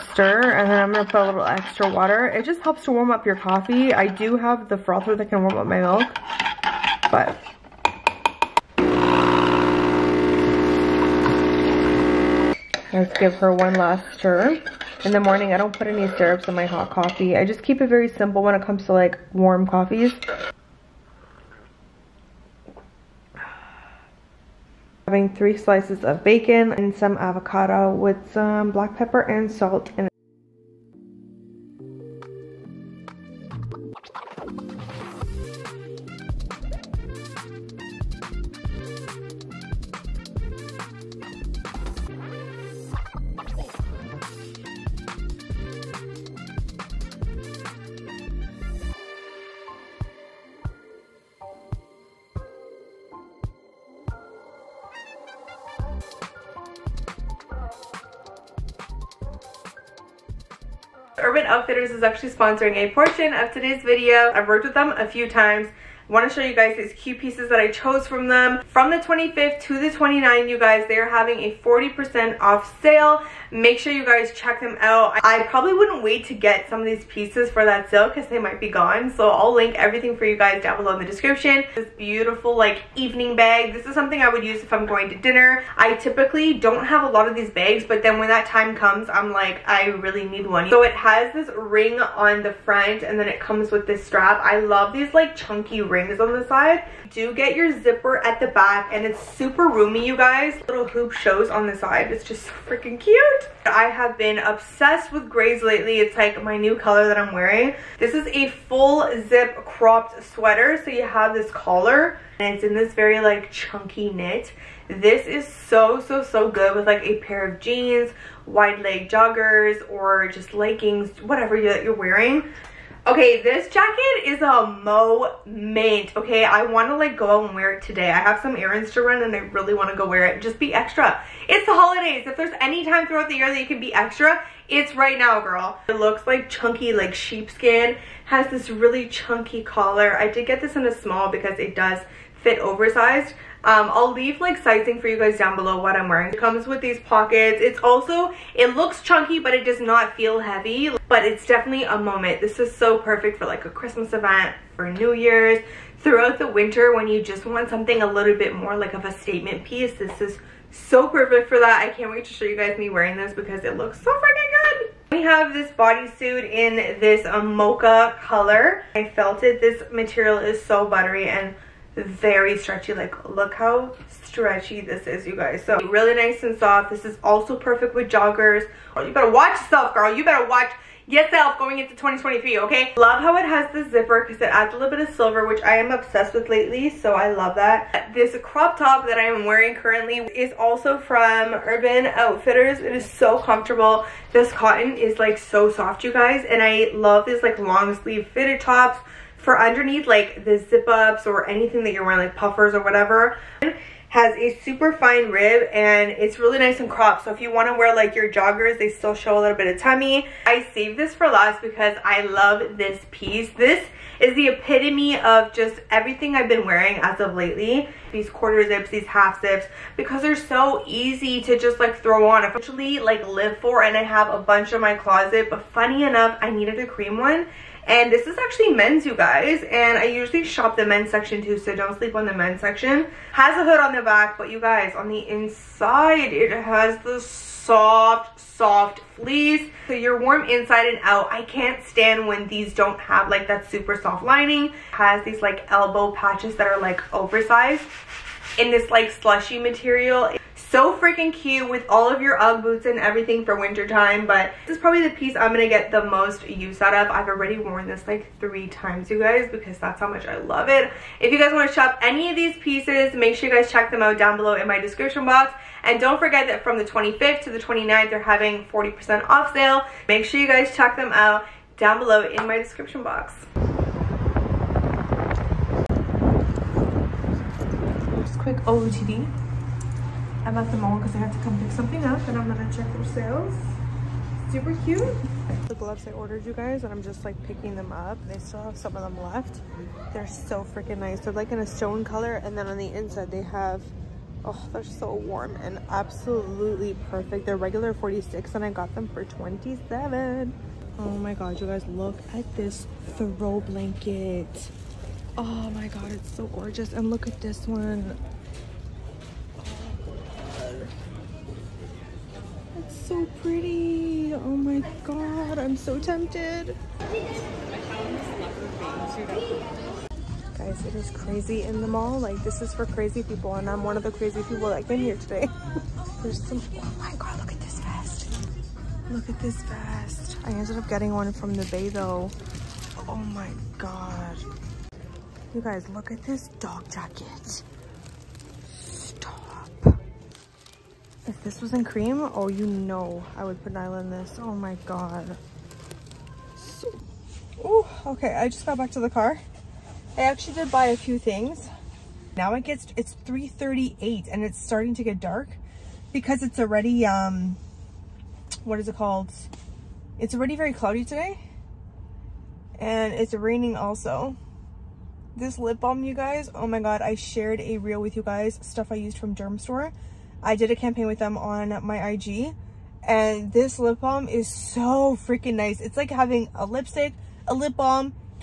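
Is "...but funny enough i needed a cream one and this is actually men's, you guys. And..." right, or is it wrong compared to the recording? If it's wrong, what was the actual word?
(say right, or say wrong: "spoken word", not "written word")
right.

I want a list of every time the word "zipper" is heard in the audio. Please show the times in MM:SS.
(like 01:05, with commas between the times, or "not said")
01:37, 03:03.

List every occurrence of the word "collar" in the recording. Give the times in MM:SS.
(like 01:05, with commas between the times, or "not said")
01:51, 02:19.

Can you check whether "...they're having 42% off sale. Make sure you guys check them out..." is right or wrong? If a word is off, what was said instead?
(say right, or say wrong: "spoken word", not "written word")
wrong: "40", not "42".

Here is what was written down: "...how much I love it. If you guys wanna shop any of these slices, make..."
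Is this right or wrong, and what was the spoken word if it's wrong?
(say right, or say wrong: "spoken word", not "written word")
wrong: "pieces", not "slices".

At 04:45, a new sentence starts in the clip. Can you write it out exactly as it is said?
The gloves I ordered you guys and I'm just like picking them up.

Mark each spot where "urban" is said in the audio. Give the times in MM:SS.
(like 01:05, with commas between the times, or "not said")
01:01, 03:11.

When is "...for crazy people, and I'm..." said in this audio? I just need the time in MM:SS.
05:22.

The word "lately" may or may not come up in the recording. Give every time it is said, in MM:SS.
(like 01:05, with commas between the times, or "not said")
01:45, 03:06, 03:37.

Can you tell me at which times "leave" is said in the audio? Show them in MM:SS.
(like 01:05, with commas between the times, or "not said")
02:24.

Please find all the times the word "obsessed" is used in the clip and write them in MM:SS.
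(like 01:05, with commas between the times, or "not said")
01:44, 03:05.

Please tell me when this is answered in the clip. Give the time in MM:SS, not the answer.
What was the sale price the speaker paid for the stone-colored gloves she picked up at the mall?
04:59.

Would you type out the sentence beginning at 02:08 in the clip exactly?
I have some errands to run and I really want to go wear it.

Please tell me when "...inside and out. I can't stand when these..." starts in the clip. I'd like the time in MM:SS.
04:00.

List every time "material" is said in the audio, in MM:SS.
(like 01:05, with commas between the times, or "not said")
02:49, 04:09.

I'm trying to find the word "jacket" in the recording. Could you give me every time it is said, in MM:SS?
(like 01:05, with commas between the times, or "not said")
02:03, 05:36.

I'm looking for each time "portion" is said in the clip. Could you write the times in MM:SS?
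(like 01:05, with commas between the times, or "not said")
01:02.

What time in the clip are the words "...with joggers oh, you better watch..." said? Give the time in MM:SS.
02:57.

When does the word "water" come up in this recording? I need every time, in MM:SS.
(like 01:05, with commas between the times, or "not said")
00:01.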